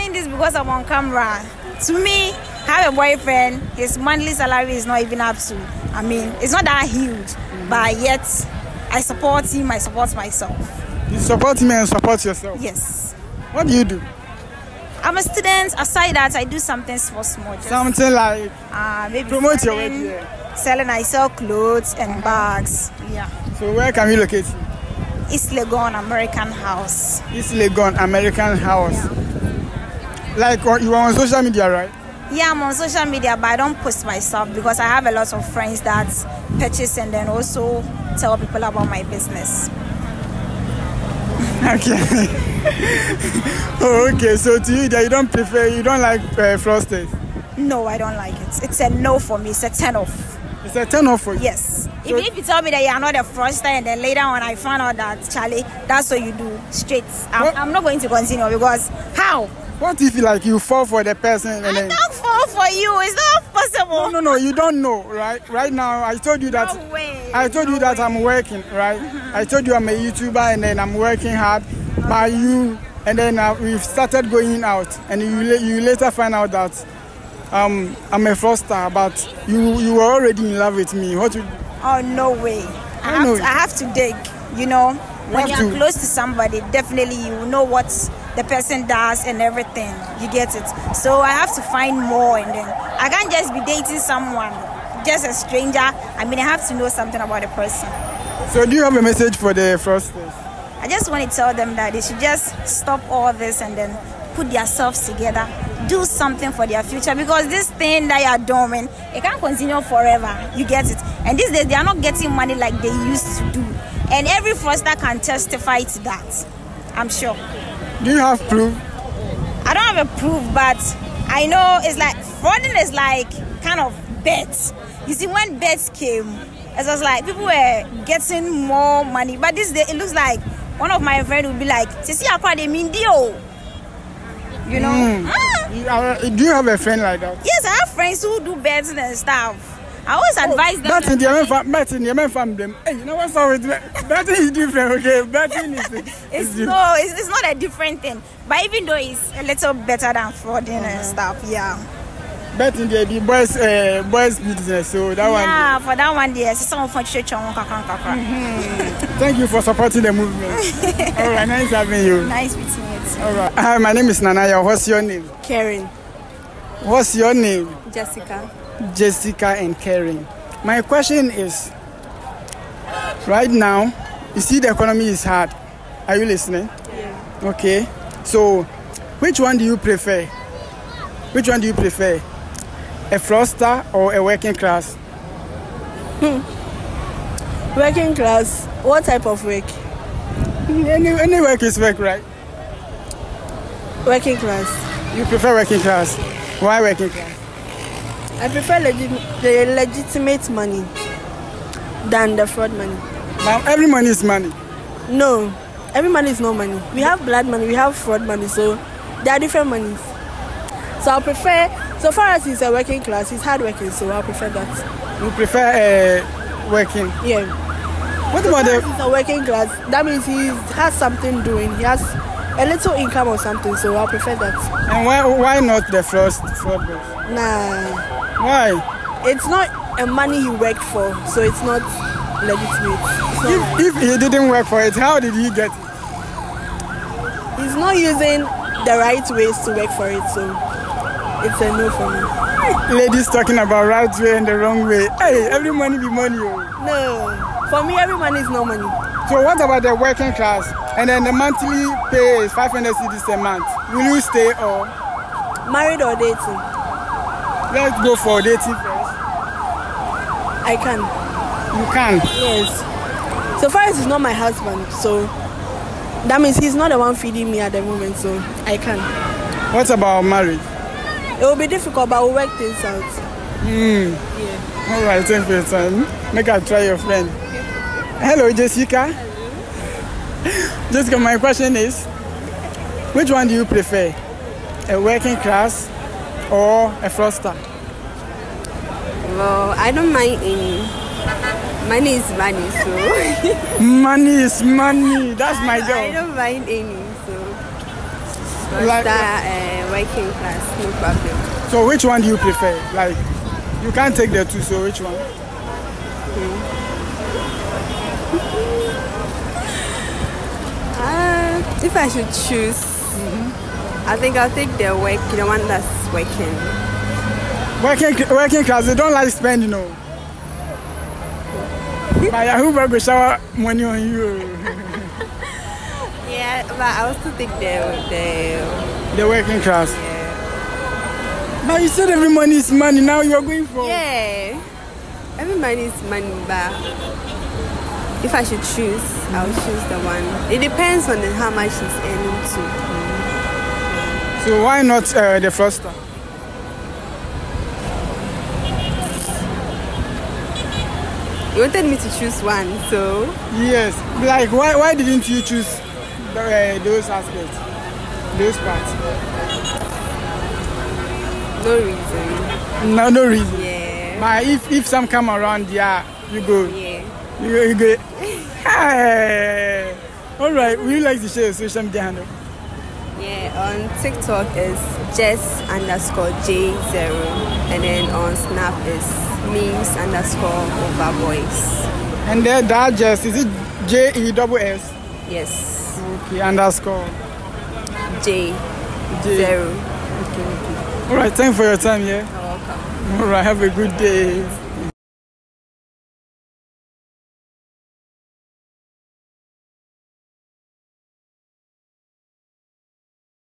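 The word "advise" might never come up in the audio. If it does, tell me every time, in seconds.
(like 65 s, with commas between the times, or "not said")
140 s.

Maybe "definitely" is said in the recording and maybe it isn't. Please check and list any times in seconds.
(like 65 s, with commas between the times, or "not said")
86 s.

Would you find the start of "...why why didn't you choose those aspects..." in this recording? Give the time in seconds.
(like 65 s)
354 s.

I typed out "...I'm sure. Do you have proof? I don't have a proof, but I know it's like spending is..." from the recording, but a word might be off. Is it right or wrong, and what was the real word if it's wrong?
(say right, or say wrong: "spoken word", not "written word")
wrong: "frauding", not "spending".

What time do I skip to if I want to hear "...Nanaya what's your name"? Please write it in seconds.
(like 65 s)
164 s.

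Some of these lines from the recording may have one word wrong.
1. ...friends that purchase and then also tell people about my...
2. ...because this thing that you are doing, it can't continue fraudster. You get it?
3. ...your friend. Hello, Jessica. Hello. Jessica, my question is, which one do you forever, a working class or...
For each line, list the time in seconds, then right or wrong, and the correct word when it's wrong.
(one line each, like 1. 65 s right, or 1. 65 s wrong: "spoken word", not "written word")
1. 35 s right
2. 107 s wrong: "forever", not "fraudster"
3. 276 s wrong: "prefer", not "forever".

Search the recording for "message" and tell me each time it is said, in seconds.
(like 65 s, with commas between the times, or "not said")
99 s.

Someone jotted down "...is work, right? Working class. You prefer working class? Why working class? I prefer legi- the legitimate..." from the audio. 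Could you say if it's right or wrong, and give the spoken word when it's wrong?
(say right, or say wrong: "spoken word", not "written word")
right.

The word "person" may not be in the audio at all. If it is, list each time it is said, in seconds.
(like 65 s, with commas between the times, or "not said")
61 s, 88 s, 97 s.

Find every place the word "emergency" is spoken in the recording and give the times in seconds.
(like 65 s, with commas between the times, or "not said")
not said.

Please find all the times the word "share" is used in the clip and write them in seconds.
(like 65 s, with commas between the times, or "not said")
371 s.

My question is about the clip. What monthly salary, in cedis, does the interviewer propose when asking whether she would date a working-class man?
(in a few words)
500 cedis.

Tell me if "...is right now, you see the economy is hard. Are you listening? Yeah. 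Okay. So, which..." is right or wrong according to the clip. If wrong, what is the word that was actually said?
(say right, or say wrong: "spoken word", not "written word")
right.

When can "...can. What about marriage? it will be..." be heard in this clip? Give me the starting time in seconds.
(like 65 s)
268 s.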